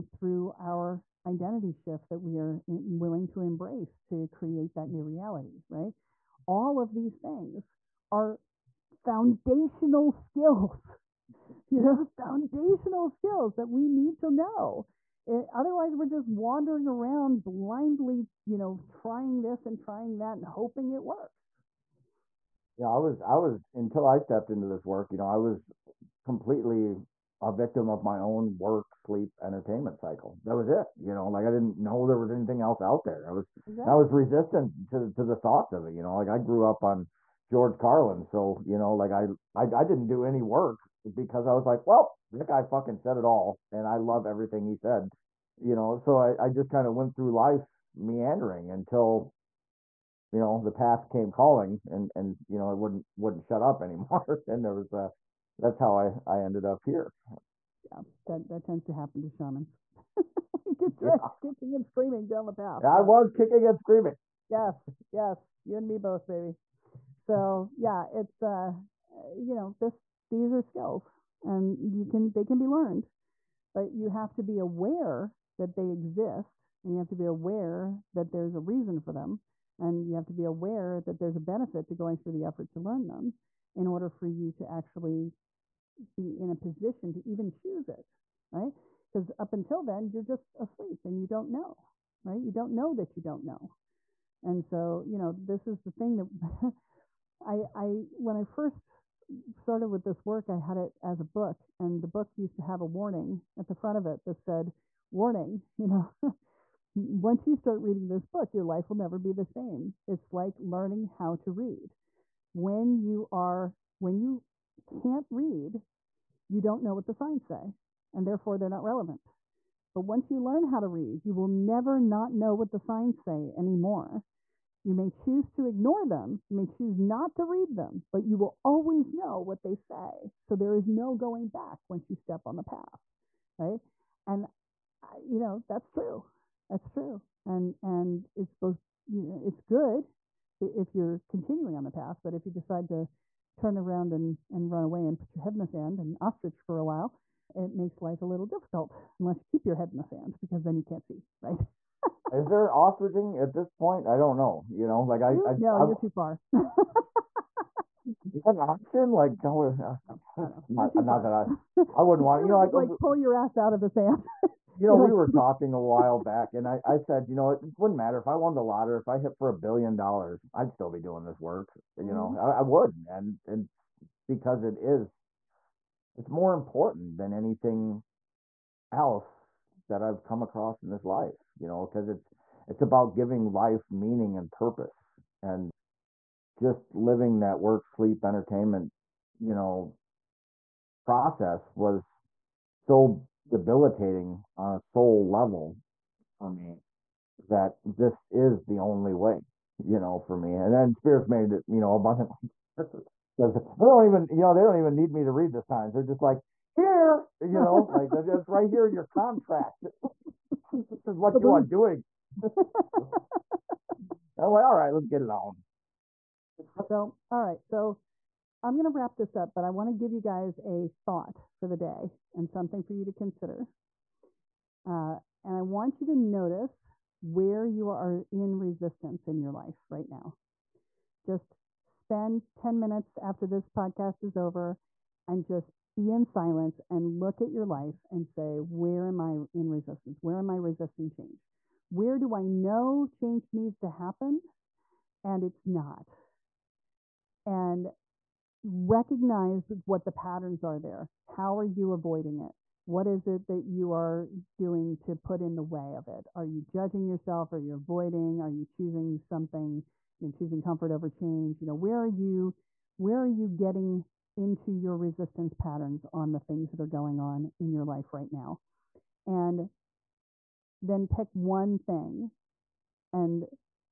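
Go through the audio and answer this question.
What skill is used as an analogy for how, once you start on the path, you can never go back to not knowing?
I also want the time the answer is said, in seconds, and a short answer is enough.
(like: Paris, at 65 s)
learning how to read, at 110 s.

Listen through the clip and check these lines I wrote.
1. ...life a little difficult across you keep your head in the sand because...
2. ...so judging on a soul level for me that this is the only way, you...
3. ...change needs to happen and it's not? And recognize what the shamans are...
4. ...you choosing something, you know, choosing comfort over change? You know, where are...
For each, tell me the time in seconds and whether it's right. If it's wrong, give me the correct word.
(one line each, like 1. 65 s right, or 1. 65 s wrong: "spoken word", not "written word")
1. 147 s wrong: "unless", not "across"
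2. 192 s wrong: "debilitating", not "judging"
3. 243 s wrong: "patterns", not "shamans"
4. 258 s right.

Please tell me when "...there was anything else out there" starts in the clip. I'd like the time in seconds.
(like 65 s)
32 s.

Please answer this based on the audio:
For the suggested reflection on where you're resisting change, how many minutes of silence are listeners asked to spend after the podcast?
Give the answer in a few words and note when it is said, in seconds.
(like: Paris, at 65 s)
10, at 232 s.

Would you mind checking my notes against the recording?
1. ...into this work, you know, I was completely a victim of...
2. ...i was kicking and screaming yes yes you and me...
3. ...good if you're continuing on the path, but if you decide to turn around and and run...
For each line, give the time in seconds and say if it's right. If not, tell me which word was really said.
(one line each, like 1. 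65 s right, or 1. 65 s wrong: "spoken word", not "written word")
1. 24 s right
2. 62 s right
3. 139 s right.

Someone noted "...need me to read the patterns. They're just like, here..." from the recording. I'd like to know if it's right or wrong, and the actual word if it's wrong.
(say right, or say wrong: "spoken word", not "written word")
wrong: "signs", not "patterns".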